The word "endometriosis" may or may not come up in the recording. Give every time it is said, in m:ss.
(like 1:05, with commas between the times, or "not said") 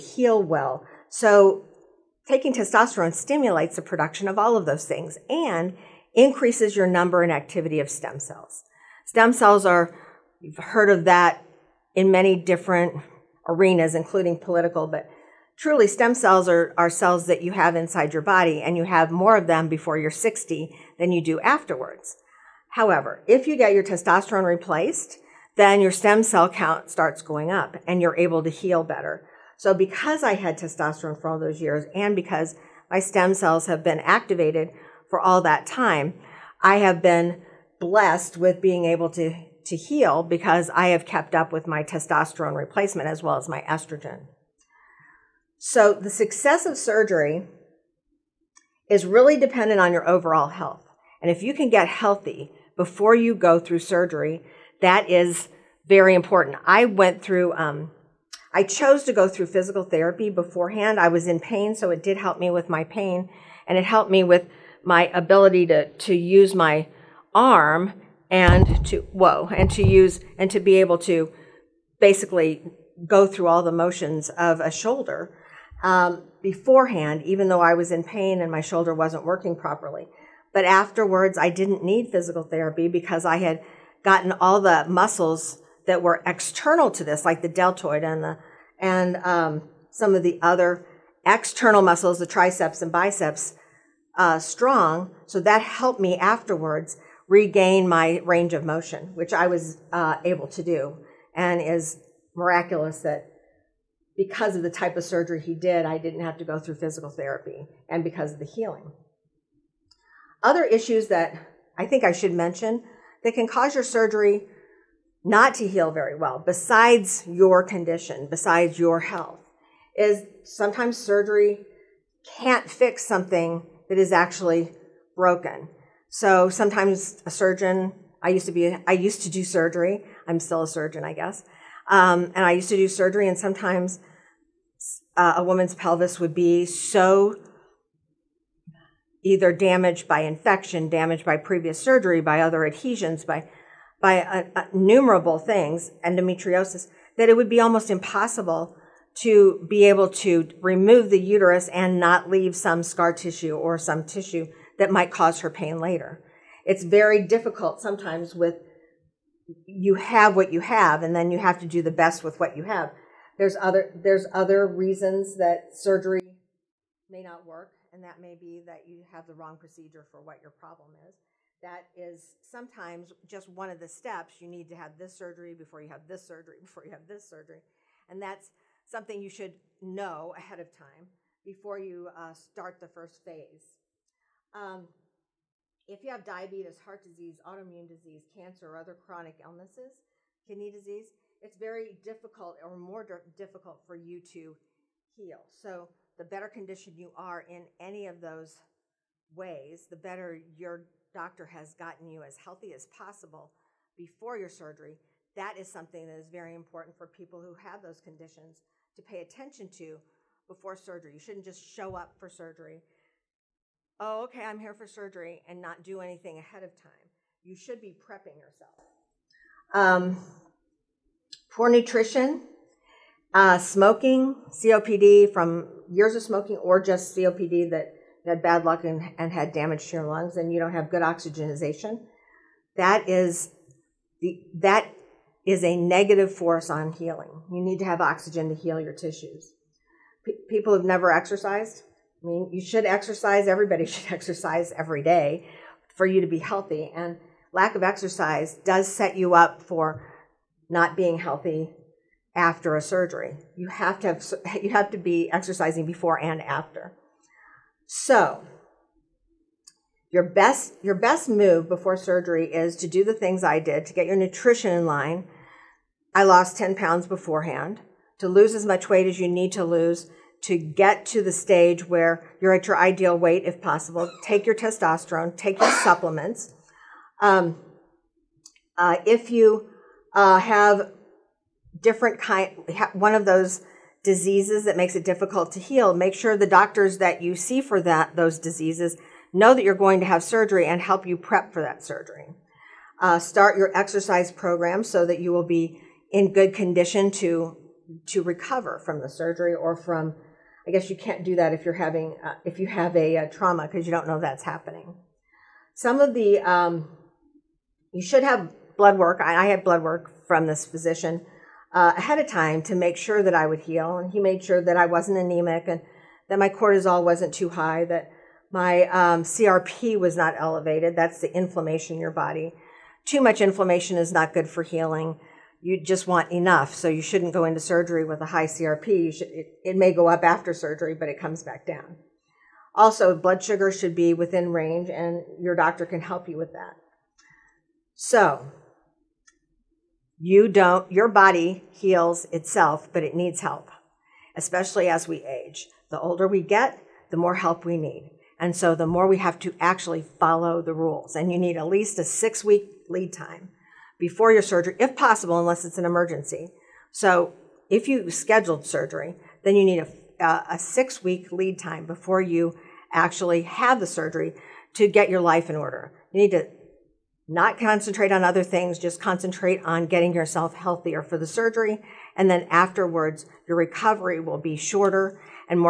2:26.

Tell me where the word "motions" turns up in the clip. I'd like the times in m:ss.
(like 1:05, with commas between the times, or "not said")
1:13, 1:38.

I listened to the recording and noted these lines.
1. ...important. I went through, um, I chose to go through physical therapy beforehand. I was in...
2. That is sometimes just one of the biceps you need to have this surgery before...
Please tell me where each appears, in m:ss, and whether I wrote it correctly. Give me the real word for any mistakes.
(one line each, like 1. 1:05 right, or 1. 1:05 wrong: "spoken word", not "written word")
1. 0:56 right
2. 2:51 wrong: "steps", not "biceps".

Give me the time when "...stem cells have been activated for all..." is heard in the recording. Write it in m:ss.
0:32.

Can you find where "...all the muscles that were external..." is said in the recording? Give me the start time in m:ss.
1:24.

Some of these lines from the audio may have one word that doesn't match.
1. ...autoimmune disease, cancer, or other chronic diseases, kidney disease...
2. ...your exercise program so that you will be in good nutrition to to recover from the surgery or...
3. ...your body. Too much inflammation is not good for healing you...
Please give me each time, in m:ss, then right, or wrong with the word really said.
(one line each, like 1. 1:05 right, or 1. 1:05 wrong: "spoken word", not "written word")
1. 3:07 wrong: "illnesses", not "diseases"
2. 4:53 wrong: "condition", not "nutrition"
3. 5:22 right.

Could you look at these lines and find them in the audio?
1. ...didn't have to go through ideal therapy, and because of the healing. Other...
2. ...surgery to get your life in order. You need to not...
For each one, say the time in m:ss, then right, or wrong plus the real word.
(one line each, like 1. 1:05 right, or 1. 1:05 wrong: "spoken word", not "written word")
1. 1:45 wrong: "physical", not "ideal"
2. 6:03 right.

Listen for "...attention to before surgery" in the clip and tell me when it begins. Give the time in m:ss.
3:29.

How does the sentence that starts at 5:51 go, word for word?
And you need at least a six week lead time before your surgery, if possible, unless it's an emergency.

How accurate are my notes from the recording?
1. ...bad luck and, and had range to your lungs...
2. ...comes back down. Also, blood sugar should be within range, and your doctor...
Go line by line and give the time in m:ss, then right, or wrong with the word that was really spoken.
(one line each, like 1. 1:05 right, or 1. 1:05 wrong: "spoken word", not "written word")
1. 3:48 wrong: "damage", not "range"
2. 5:31 right.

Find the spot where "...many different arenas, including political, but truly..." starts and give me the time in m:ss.
0:12.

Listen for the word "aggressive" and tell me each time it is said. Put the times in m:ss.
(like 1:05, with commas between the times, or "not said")
not said.